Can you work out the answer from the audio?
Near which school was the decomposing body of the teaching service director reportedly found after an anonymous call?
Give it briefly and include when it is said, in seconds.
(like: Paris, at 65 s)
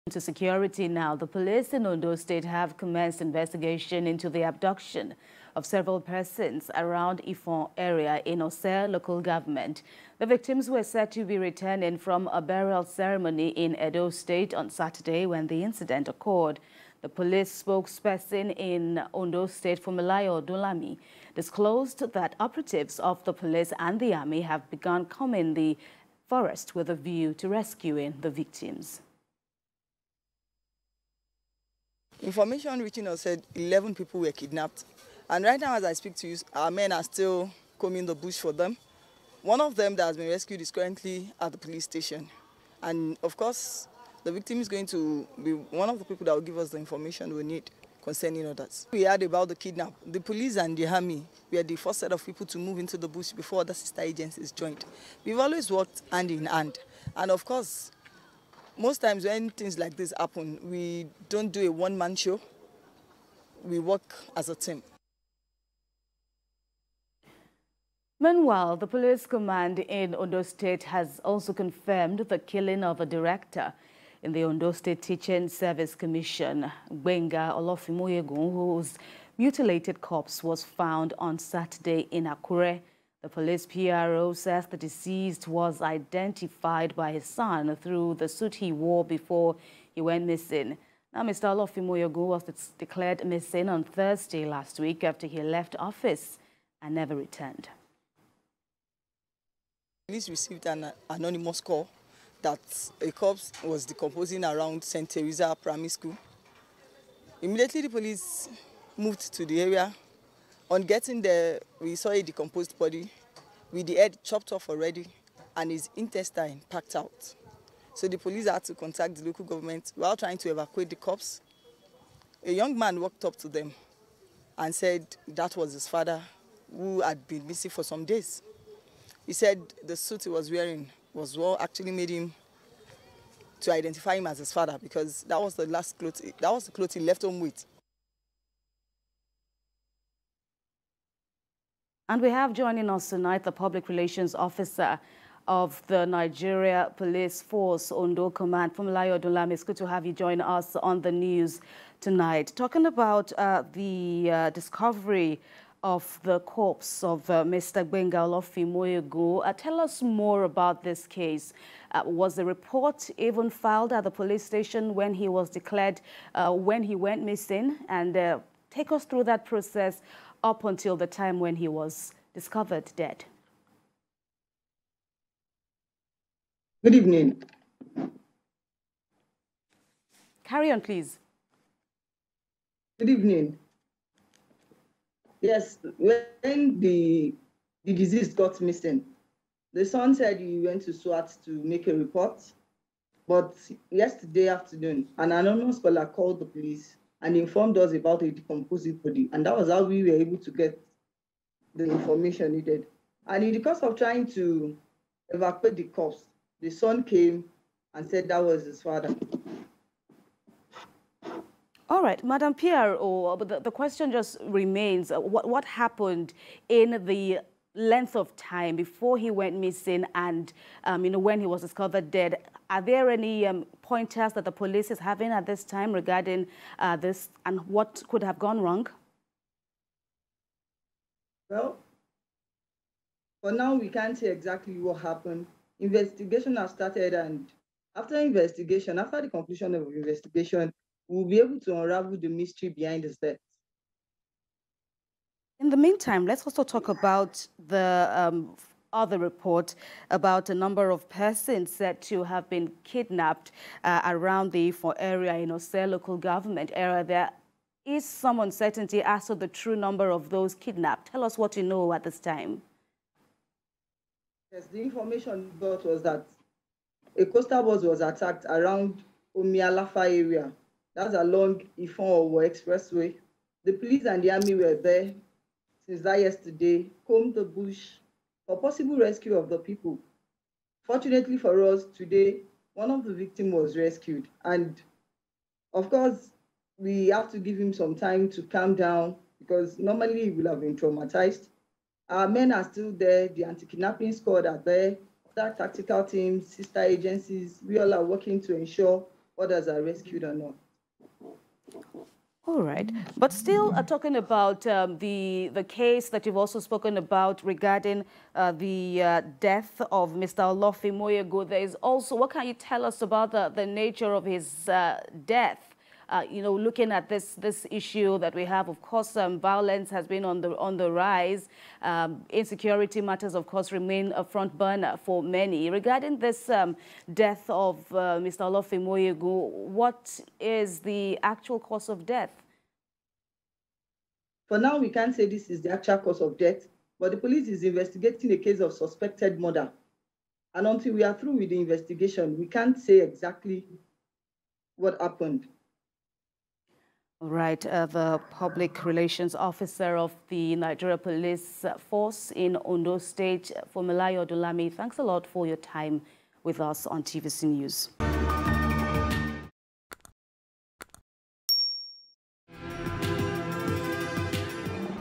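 St. Teresa Primary School, at 104 s.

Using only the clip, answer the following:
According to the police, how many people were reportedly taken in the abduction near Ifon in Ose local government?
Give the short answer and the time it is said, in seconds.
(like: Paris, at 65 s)
11, at 33 s.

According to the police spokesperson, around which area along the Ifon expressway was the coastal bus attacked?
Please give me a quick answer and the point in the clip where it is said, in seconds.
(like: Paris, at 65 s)
Omialafa, at 269 s.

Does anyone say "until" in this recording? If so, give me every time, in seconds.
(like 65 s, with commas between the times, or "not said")
170 s, 340 s.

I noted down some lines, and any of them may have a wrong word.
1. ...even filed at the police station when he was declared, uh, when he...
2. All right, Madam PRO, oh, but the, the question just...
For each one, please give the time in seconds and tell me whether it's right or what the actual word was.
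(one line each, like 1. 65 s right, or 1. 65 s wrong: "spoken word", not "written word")
1. 163 s right
2. 211 s right.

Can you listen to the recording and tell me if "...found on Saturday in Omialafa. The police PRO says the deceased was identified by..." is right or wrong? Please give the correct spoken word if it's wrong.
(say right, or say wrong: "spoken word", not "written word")
wrong: "Akure", not "Omialafa".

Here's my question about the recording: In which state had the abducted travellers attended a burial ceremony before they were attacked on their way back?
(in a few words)
Edo State.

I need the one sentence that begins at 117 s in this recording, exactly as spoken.
So the police had to contact the local government while trying to evacuate the cops.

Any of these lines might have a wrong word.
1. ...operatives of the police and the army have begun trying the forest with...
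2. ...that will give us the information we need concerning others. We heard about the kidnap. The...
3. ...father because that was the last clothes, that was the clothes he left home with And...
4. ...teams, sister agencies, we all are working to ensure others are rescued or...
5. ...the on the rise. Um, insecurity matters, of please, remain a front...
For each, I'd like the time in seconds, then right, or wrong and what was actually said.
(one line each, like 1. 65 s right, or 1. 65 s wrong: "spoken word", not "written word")
1. 22 s wrong: "combing", not "trying"
2. 46 s right
3. 134 s right
4. 296 s right
5. 320 s wrong: "course", not "please".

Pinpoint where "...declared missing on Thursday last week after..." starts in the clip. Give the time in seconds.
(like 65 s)
92 s.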